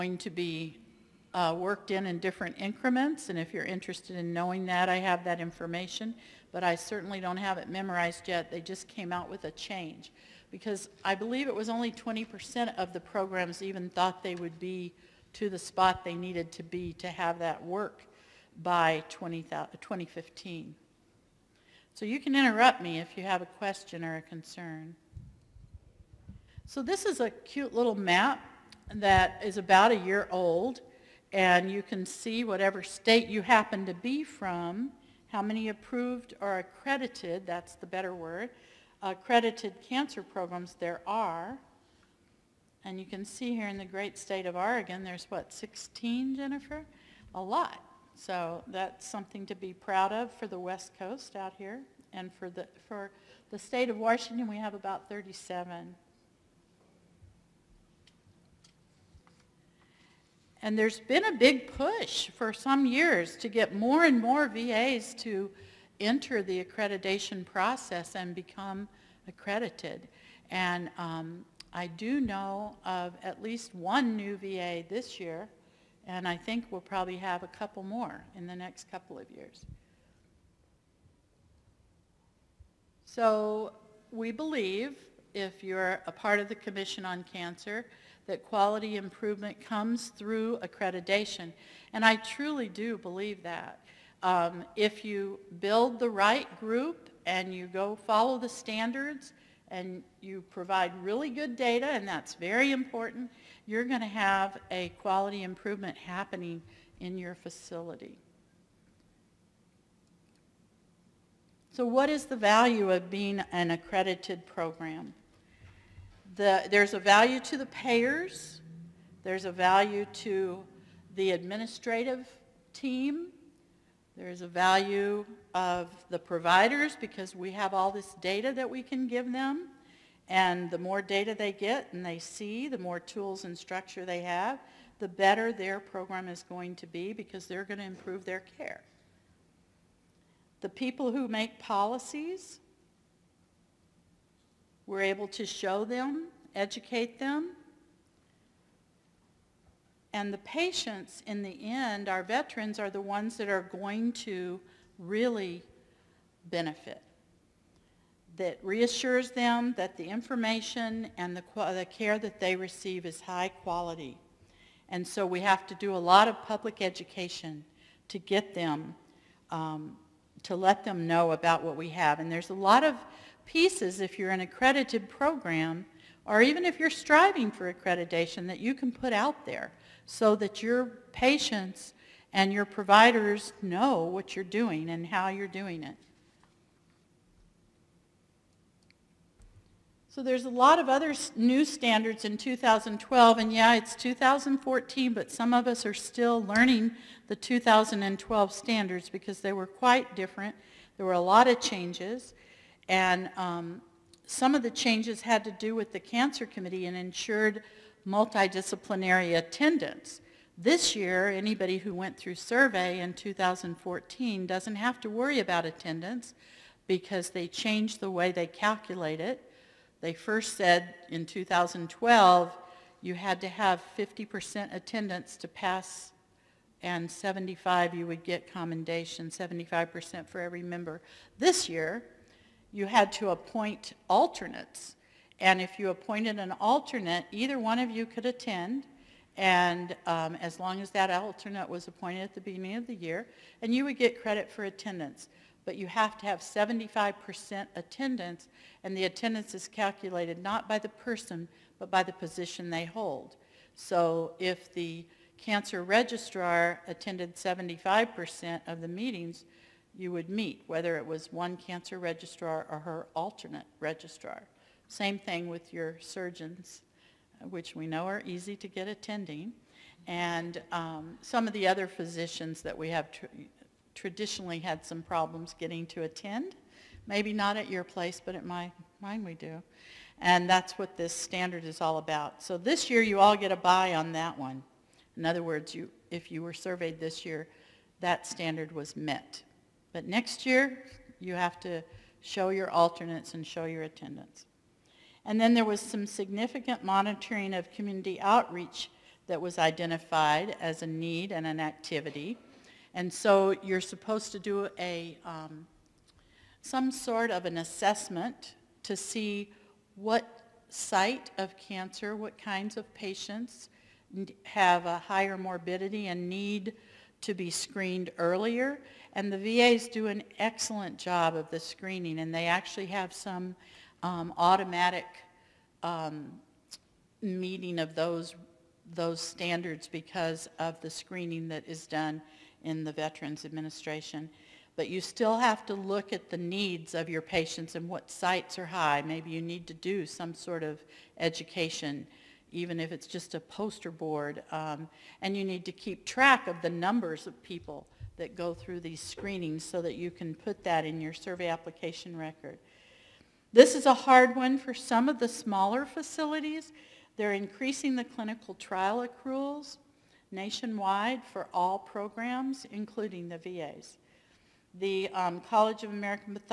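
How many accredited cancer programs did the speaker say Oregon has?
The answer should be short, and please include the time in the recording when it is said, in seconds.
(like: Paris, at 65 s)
16, at 45 s.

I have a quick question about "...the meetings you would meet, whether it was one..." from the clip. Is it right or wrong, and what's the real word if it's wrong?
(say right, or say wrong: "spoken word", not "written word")
right.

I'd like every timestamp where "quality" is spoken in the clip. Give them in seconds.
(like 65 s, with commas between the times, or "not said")
88 s, 105 s, 163 s.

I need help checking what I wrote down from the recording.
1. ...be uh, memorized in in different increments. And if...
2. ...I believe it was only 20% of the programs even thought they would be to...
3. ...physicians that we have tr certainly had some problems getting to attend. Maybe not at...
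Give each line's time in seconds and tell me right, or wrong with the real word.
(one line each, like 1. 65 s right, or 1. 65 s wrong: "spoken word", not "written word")
1. 0 s wrong: "worked", not "memorized"
2. 11 s right
3. 271 s wrong: "traditionally", not "certainly".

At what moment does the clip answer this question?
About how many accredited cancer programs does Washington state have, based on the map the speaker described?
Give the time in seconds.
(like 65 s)
55 s.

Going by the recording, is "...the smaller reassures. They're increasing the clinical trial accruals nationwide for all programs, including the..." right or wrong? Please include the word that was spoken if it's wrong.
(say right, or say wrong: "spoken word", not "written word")
wrong: "facilities", not "reassures".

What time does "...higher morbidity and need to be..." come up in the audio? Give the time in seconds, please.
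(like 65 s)
314 s.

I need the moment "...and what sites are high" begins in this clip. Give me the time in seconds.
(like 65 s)
337 s.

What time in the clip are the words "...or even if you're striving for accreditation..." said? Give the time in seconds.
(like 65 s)
176 s.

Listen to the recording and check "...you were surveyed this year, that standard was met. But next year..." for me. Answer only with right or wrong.
right.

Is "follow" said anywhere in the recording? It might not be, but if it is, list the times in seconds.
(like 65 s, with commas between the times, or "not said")
97 s.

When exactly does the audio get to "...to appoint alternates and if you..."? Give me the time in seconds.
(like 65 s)
233 s.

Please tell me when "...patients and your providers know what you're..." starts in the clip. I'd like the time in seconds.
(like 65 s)
181 s.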